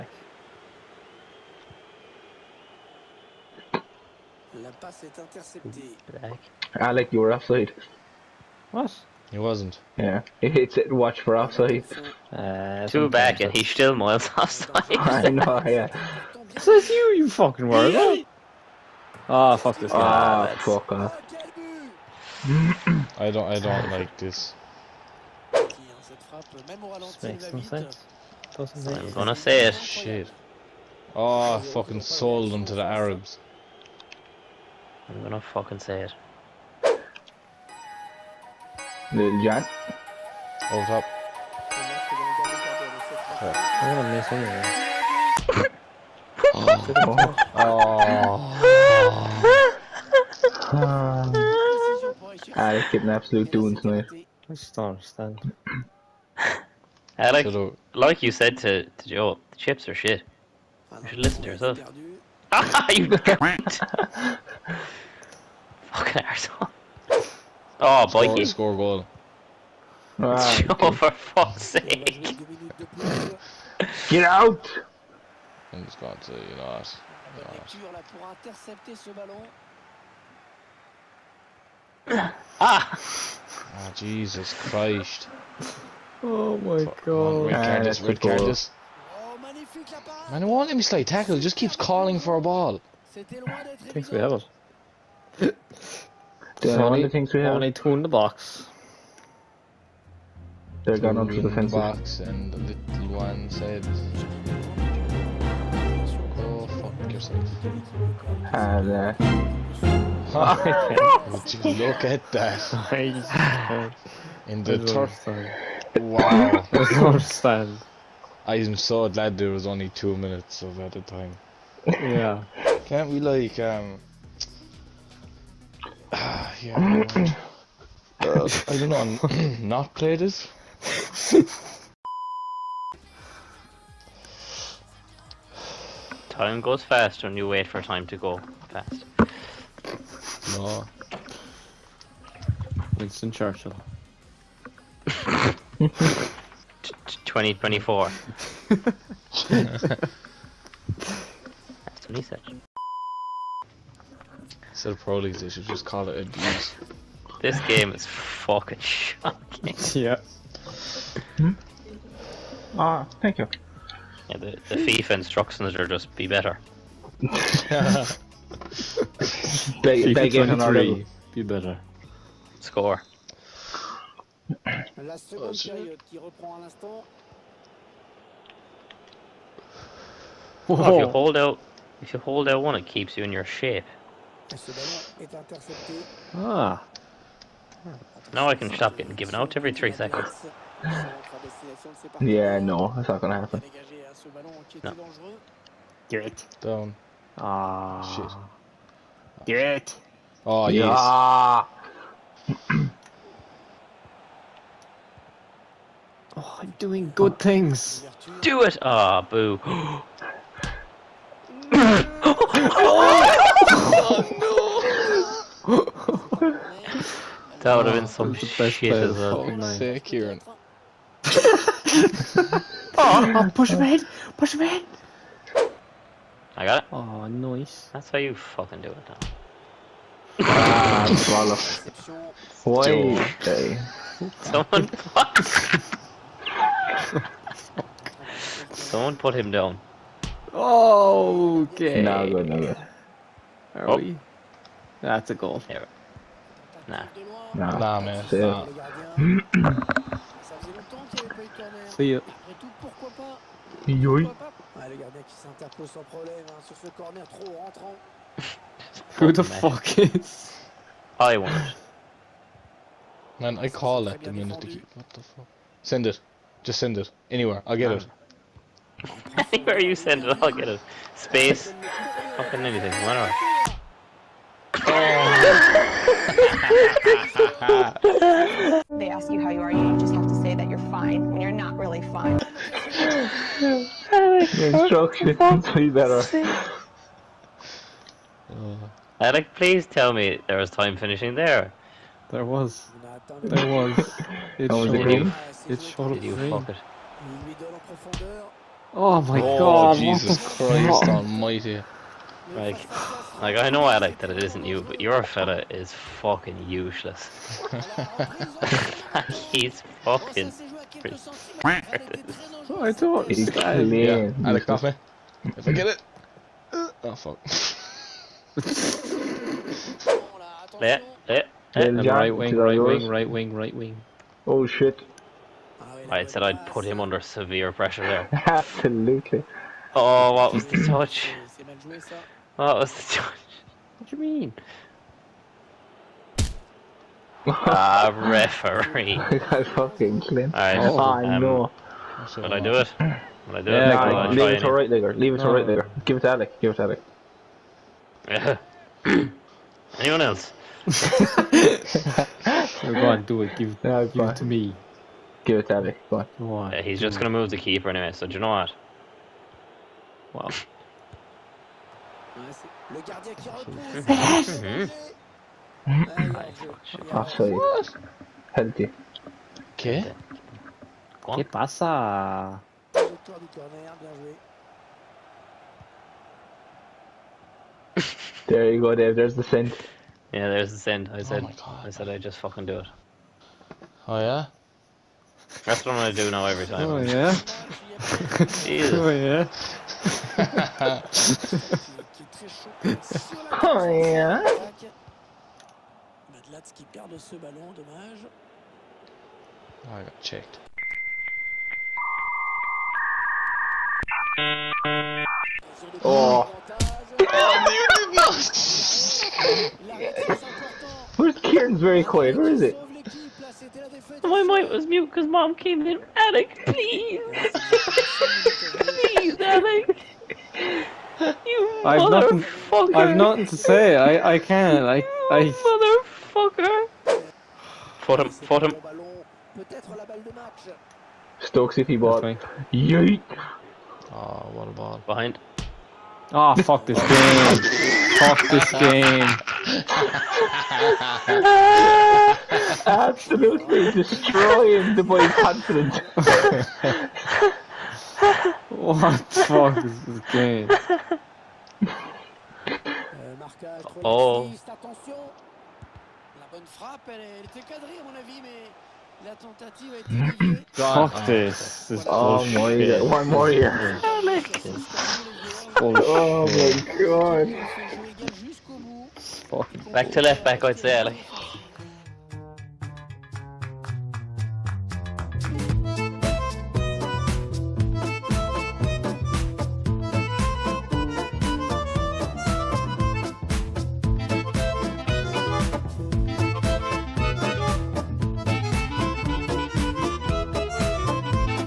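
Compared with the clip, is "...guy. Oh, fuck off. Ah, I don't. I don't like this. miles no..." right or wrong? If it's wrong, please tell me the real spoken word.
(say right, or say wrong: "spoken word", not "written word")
wrong: "makes", not "miles".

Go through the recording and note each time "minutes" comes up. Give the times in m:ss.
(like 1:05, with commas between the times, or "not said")
2:00, 4:24.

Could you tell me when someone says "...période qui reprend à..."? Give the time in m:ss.
2:55.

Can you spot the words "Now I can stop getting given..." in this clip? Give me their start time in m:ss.
3:08.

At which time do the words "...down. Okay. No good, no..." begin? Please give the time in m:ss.
3:59.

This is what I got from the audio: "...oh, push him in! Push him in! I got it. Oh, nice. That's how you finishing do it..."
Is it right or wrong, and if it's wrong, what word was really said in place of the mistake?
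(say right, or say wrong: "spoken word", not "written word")
wrong: "fucking", not "finishing".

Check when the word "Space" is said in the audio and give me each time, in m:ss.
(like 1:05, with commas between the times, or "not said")
4:31.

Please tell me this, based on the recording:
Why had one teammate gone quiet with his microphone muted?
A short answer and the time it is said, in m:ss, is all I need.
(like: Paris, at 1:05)
mom came in, at 6:55.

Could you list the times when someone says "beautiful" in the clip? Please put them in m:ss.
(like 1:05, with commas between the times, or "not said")
6:48.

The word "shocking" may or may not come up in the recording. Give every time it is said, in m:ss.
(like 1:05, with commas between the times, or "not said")
2:38.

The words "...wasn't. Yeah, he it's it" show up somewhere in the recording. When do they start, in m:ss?
0:09.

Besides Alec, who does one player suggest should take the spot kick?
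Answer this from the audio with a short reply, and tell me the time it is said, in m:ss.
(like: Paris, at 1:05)
Abby, at 5:55.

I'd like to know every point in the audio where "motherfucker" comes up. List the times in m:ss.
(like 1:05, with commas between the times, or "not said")
7:02, 7:06.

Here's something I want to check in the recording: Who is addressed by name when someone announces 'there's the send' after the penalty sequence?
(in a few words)
Dave.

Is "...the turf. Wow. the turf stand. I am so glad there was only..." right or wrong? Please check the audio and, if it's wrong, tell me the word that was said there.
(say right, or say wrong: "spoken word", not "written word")
right.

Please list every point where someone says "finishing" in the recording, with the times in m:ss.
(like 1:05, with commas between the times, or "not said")
4:50.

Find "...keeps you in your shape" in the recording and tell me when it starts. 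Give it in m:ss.
3:02.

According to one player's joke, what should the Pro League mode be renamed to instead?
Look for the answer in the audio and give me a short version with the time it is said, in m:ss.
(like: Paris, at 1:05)
abuse, at 2:36.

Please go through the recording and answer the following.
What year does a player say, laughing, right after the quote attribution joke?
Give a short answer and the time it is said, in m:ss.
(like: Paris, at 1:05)
2024, at 2:27.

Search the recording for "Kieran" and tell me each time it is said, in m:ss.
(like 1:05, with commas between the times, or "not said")
3:40, 6:51.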